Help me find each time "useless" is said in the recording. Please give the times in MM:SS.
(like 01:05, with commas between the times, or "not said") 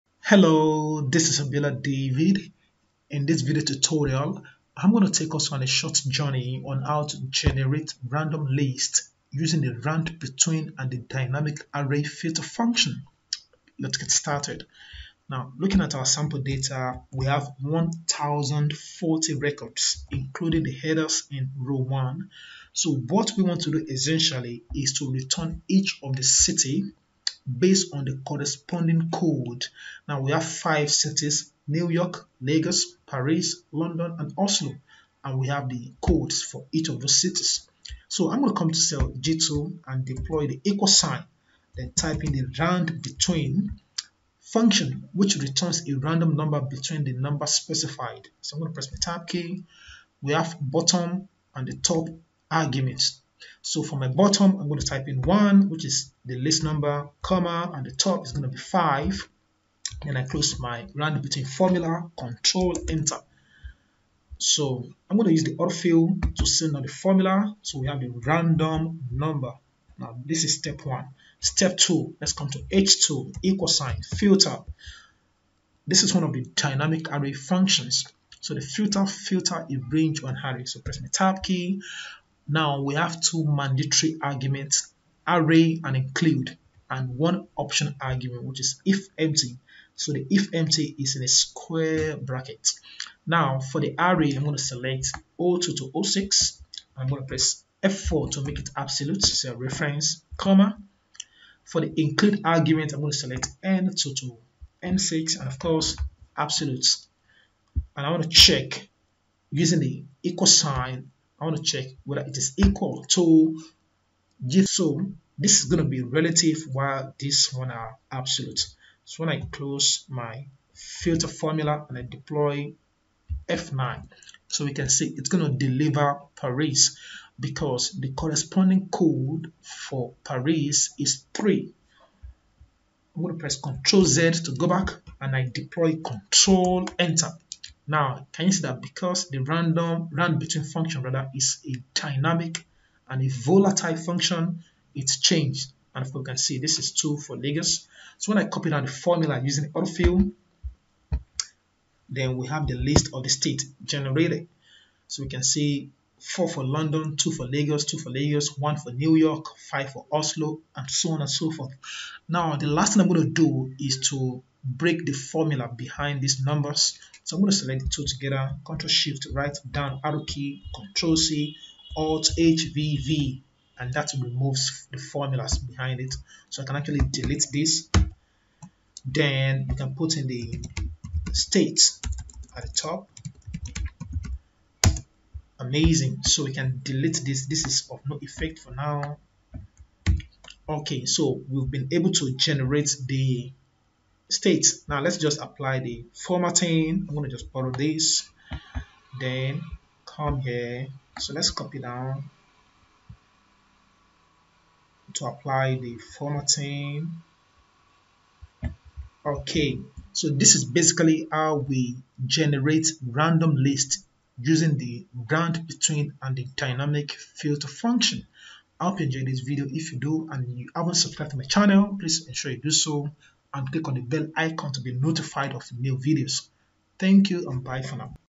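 not said.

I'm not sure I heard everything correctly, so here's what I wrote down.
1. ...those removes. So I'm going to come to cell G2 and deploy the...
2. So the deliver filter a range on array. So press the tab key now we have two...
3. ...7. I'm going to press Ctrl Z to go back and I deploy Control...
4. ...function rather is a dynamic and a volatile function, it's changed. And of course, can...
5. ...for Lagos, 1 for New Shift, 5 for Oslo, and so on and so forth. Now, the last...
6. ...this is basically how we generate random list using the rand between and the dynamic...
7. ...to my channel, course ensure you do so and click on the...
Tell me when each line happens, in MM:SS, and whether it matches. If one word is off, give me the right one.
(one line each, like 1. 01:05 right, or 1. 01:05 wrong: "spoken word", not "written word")
1. 00:36 wrong: "cities", not "removes"
2. 01:18 wrong: "filter", not "deliver"
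3. 02:11 wrong: "3", not "7"
4. 02:20 right
5. 02:37 wrong: "York", not "Shift"
6. 03:30 right
7. 03:41 wrong: "please", not "course".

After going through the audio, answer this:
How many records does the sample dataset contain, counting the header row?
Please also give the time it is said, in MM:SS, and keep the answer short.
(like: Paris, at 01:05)
1040, at 00:17.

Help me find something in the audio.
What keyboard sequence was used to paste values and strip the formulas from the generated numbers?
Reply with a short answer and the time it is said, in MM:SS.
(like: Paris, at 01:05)
Alt HVV, at 02:51.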